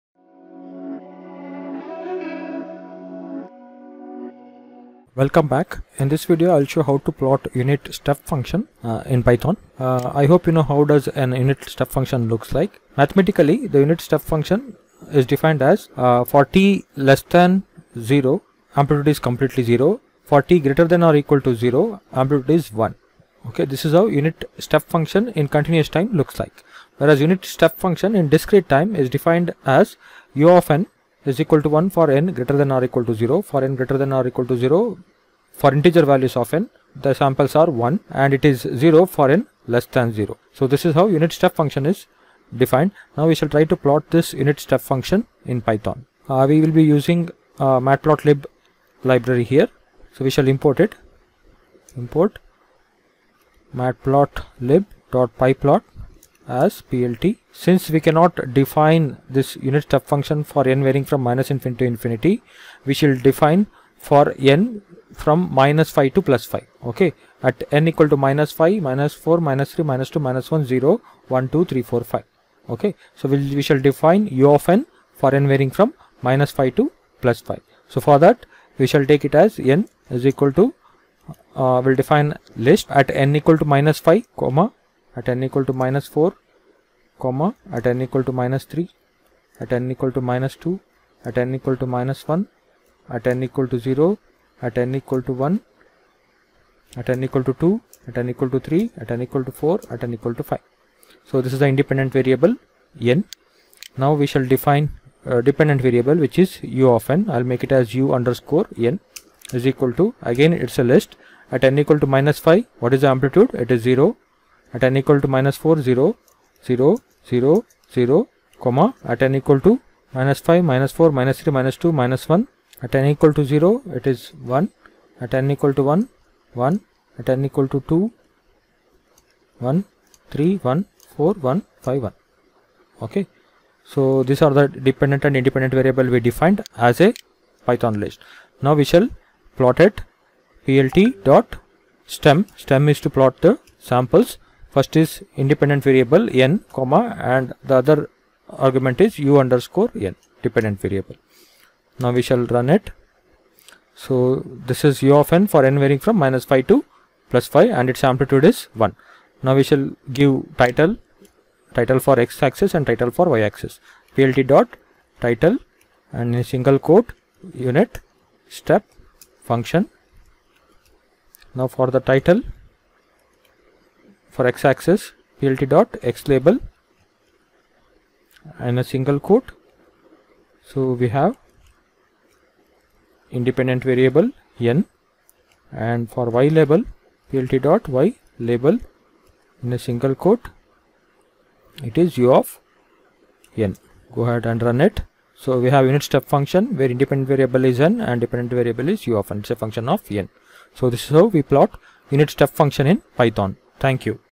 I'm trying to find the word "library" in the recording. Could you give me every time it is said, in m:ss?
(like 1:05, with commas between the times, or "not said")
0:49.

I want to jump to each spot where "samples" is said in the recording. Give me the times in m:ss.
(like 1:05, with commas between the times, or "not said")
0:37, 2:23.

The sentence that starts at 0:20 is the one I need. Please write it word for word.
For t greater than or equal to 0, amplitude is 1.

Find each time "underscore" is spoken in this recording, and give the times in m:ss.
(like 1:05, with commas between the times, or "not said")
1:48, 2:29.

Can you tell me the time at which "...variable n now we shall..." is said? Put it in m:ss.
1:42.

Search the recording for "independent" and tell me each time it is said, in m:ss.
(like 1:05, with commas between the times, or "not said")
1:41, 2:15, 2:25, 3:03, 3:16.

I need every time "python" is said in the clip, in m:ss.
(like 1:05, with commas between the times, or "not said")
0:09, 0:45, 2:17, 3:23.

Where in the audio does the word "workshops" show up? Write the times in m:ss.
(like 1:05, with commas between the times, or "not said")
not said.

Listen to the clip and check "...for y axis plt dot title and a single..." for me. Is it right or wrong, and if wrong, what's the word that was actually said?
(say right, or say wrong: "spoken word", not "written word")
right.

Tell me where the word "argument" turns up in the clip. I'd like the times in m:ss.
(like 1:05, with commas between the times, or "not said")
2:28.